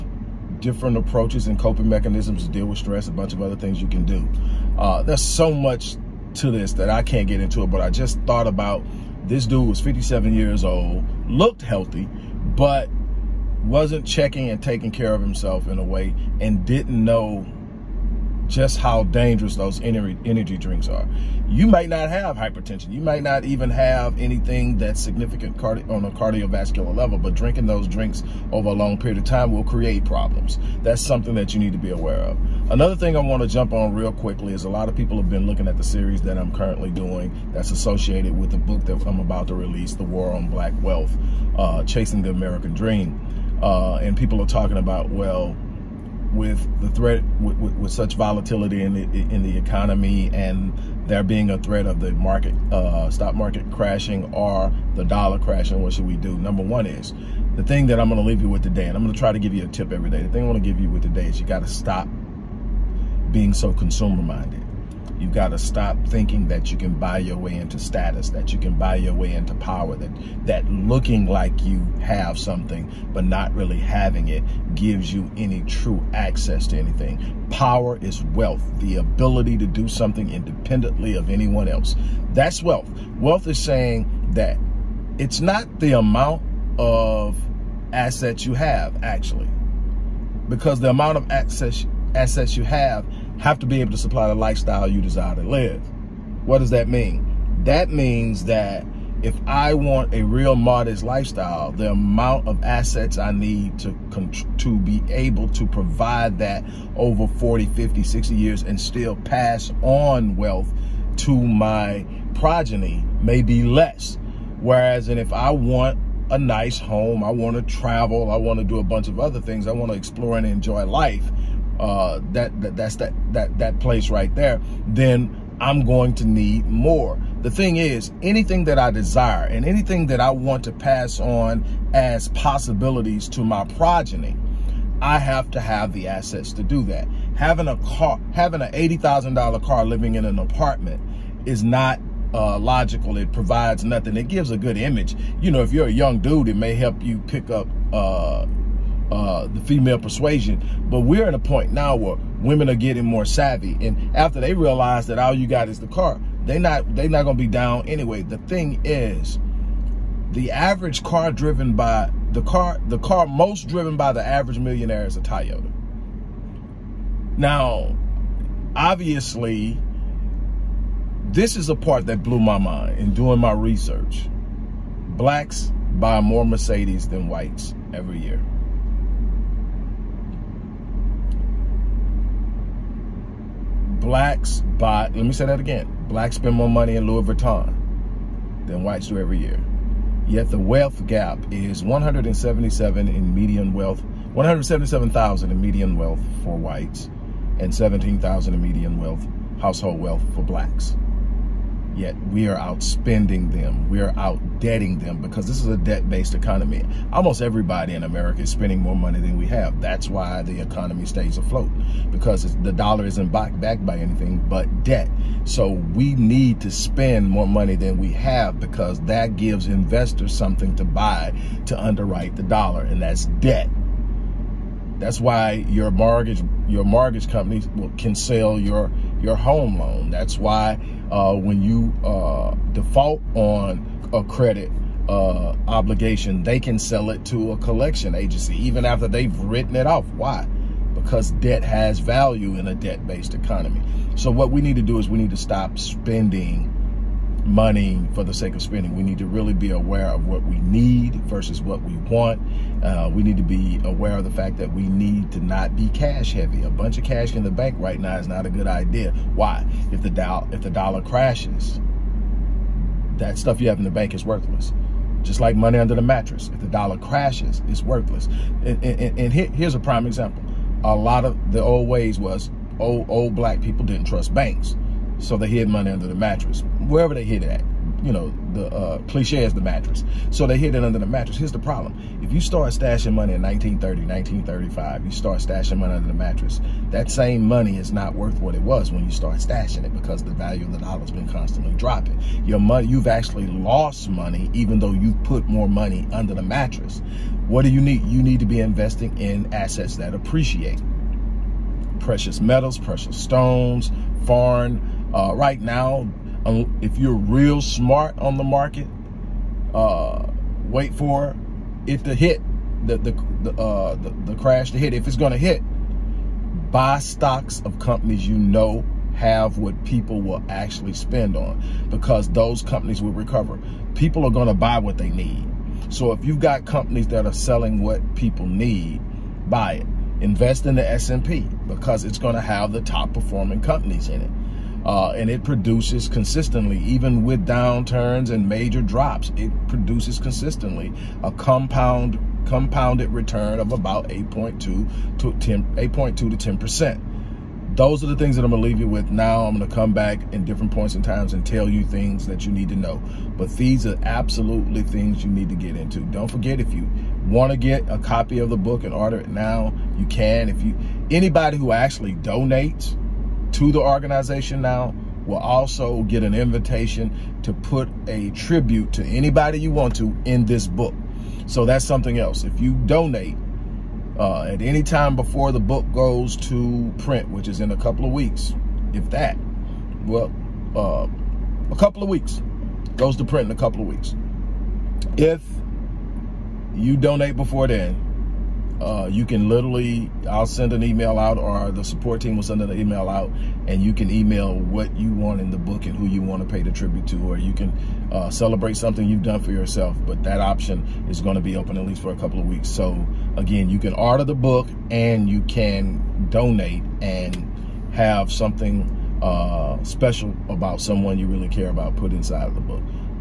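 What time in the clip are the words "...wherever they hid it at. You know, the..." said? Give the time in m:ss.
4:36.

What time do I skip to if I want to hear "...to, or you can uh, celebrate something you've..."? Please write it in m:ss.
6:37.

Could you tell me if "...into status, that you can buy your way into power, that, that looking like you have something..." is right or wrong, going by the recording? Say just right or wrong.
right.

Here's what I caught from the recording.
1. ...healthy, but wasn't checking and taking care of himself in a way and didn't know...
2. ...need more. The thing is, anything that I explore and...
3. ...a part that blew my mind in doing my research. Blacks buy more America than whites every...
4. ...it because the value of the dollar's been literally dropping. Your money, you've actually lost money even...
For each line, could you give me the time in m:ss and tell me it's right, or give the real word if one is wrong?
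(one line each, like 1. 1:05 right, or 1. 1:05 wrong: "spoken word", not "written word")
1. 0:11 right
2. 2:06 wrong: "desire", not "explore"
3. 2:51 wrong: "Mercedes", not "America"
4. 4:49 wrong: "constantly", not "literally".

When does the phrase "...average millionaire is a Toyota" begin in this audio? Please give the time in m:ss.
2:44.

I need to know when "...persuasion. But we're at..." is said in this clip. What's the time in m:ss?
2:29.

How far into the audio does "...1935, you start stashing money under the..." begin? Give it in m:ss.
4:44.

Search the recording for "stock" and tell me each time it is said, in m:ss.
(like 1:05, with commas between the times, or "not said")
0:53, 5:16.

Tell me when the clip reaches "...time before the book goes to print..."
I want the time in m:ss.
6:14.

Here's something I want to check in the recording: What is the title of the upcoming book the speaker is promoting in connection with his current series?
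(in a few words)
The War on Black Wealth.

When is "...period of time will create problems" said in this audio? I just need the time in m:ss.
0:28.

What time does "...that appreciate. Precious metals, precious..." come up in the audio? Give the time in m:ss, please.
4:59.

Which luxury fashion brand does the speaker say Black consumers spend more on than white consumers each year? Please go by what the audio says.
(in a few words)
Louis Vuitton.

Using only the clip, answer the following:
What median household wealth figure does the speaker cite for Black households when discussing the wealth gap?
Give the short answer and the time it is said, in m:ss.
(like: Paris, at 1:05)
$17,000, at 3:17.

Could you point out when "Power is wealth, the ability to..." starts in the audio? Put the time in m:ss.
1:17.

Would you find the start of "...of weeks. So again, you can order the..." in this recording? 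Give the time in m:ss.
6:42.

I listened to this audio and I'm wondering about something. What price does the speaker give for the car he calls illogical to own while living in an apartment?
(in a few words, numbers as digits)
$80,000.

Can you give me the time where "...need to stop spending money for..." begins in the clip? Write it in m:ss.
4:05.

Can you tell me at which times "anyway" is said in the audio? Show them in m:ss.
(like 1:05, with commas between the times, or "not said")
2:37.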